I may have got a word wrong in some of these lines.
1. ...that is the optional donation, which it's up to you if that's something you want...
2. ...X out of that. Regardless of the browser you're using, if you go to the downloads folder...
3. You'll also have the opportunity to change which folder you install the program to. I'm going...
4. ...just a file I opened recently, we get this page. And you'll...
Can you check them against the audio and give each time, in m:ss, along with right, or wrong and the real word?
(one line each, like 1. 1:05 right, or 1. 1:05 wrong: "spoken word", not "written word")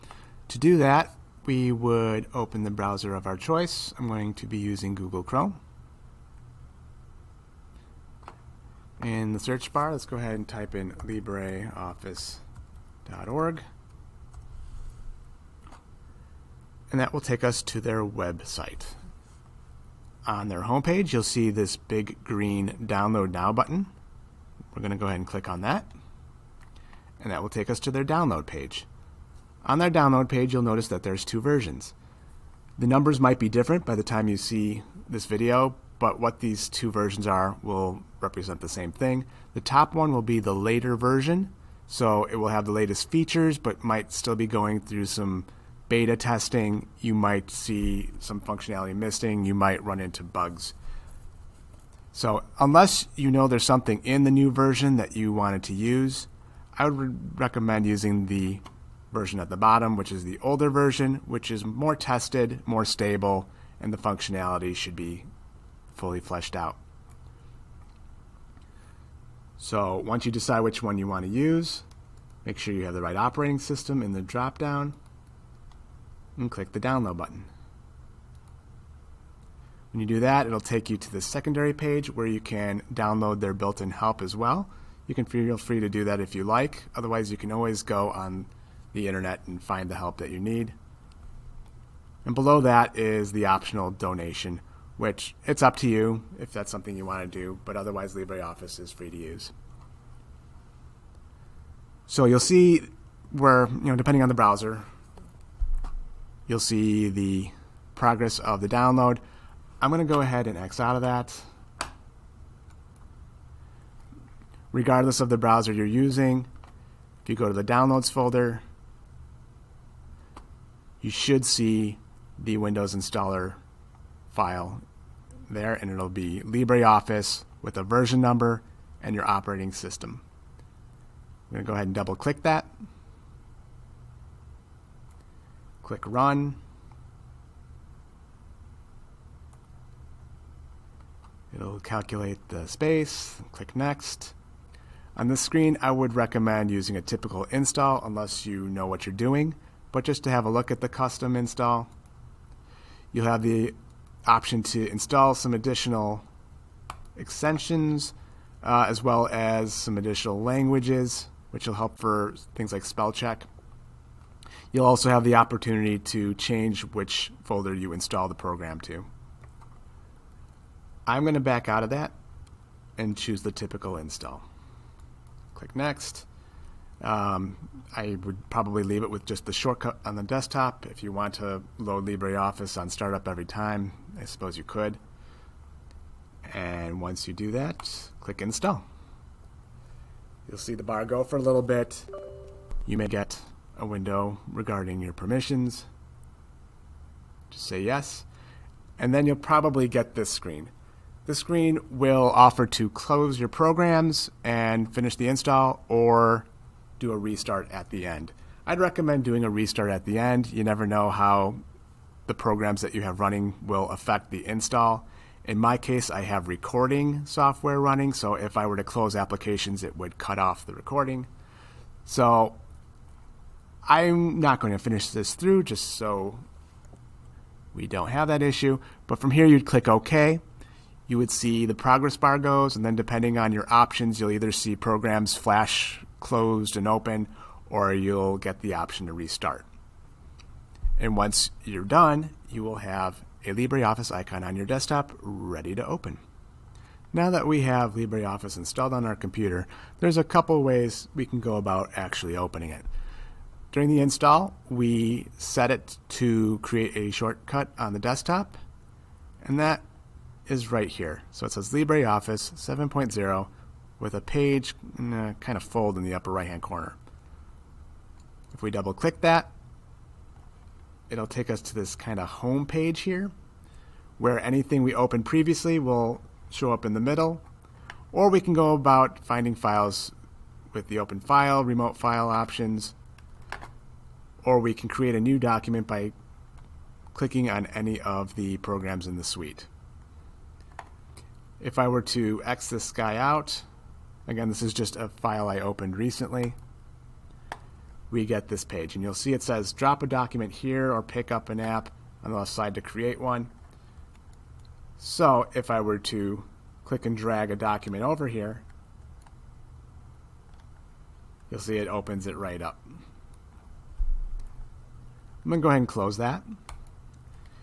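1. 1:32 right
2. 1:50 right
3. 2:44 right
4. 4:54 right.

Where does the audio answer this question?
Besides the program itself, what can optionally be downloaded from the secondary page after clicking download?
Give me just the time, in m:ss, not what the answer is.
1:23.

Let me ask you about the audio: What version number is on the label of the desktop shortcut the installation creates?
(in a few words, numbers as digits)
7.0.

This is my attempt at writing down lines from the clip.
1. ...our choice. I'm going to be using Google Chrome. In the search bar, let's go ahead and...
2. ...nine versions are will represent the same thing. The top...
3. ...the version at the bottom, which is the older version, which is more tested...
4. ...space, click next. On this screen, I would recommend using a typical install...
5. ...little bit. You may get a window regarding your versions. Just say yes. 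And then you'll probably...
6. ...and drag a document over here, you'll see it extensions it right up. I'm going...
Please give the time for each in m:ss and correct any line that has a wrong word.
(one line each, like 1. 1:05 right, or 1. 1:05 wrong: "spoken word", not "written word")
1. 0:03 right
2. 0:36 wrong: "two", not "nine"
3. 0:58 right
4. 2:22 right
5. 3:11 wrong: "permissions", not "versions"
6. 5:07 wrong: "opens", not "extensions".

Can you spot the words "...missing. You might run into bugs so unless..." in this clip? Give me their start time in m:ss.
0:48.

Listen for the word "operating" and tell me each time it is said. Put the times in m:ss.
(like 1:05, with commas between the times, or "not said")
1:13, 2:09.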